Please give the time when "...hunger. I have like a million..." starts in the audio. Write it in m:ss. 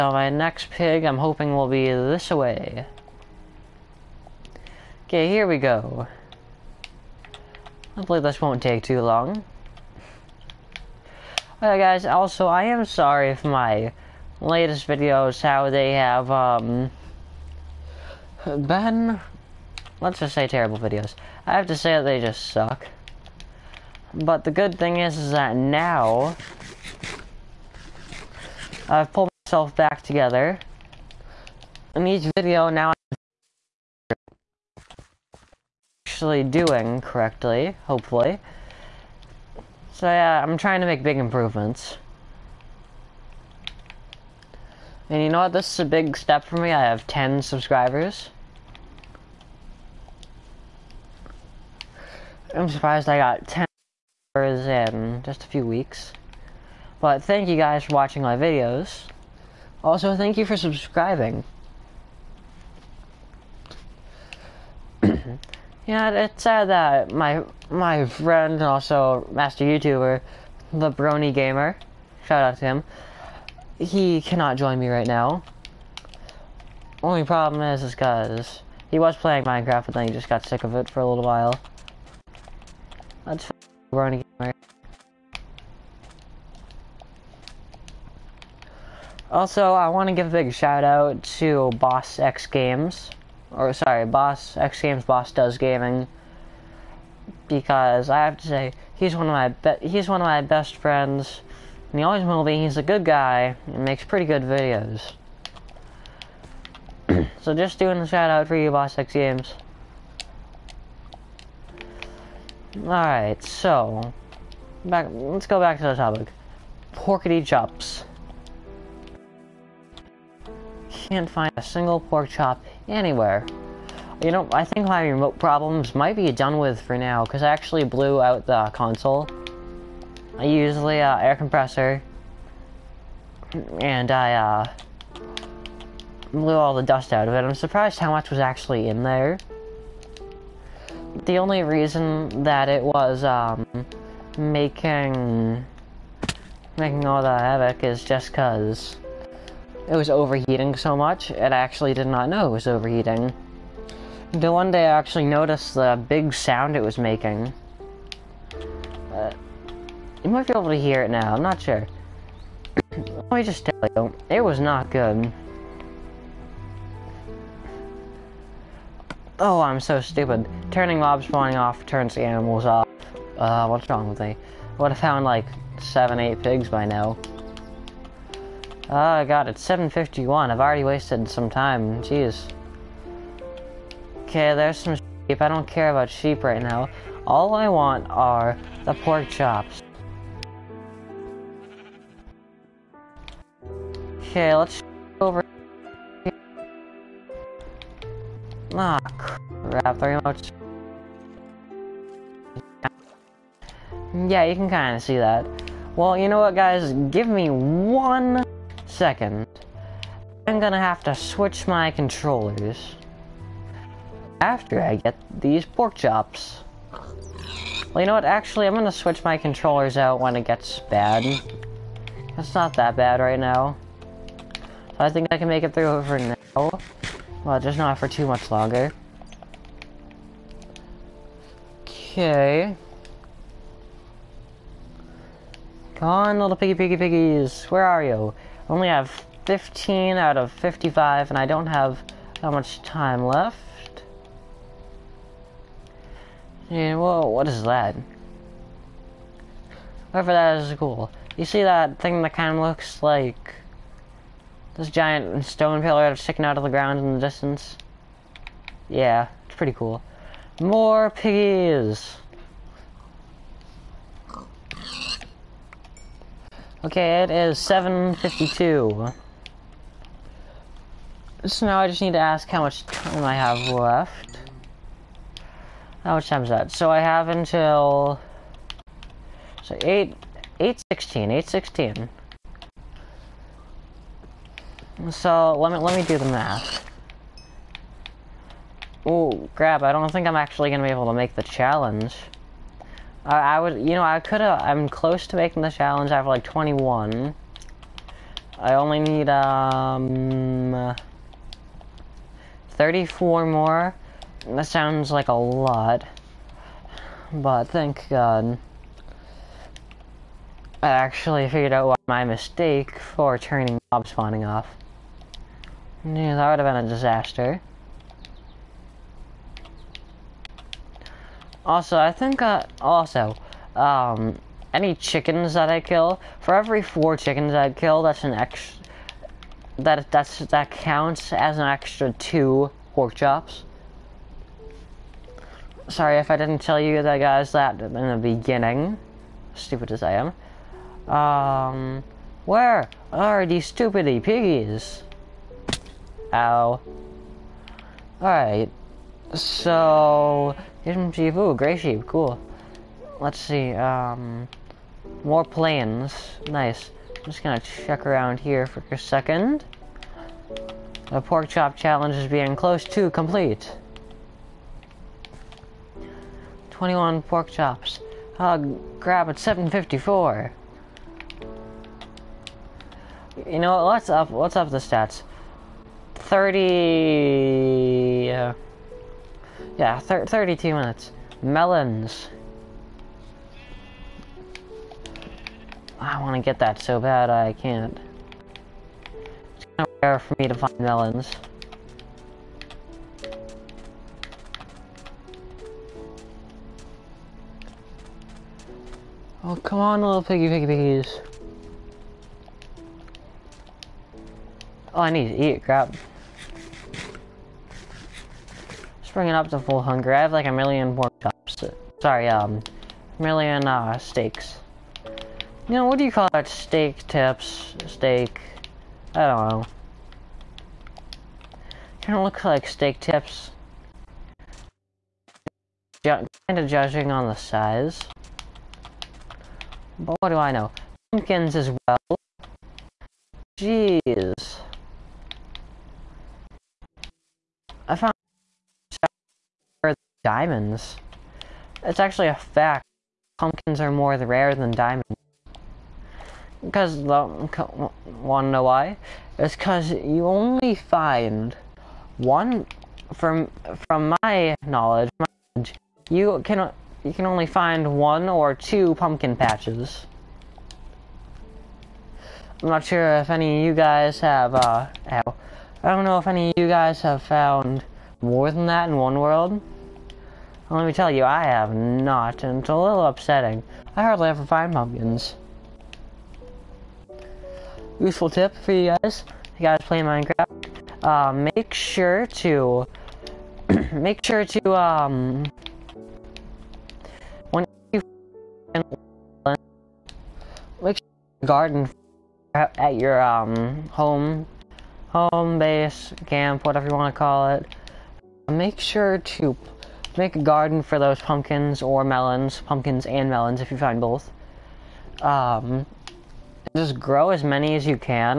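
6:49.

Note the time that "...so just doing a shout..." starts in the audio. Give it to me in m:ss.
1:47.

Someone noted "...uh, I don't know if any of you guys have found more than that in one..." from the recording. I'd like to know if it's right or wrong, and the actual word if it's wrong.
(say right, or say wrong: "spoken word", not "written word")
right.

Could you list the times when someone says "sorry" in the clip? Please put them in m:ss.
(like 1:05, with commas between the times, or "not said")
0:12, 1:33, 5:35, 6:52.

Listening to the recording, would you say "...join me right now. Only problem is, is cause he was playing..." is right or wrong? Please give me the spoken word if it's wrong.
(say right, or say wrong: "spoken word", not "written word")
right.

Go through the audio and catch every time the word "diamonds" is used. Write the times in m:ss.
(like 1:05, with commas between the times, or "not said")
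7:20, 7:24.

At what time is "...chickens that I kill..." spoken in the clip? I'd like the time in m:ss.
5:24.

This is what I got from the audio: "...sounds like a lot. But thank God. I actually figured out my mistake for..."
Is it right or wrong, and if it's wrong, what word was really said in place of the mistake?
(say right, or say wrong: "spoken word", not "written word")
right.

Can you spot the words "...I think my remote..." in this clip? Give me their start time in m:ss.
2:04.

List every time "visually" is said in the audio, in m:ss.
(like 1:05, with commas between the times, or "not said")
not said.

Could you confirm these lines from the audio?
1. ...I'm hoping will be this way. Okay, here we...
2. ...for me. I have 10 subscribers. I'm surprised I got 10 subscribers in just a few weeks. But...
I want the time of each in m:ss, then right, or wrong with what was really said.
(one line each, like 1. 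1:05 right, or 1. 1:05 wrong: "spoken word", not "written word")
1. 0:01 right
2. 0:46 right.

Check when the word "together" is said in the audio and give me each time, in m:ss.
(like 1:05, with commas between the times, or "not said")
0:30.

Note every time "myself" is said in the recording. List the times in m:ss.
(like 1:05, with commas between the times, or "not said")
0:29.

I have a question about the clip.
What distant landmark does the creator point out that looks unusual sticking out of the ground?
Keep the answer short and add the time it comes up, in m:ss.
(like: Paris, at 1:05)
giant stone pillar, at 4:14.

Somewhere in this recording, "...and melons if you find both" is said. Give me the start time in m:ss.
8:23.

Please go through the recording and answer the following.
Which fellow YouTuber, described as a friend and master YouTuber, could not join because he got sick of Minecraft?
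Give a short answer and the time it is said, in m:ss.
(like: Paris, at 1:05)
the Brony Gamer, at 1:10.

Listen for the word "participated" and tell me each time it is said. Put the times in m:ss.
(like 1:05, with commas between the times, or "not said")
not said.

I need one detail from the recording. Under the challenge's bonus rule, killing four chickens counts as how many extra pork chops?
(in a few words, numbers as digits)
2.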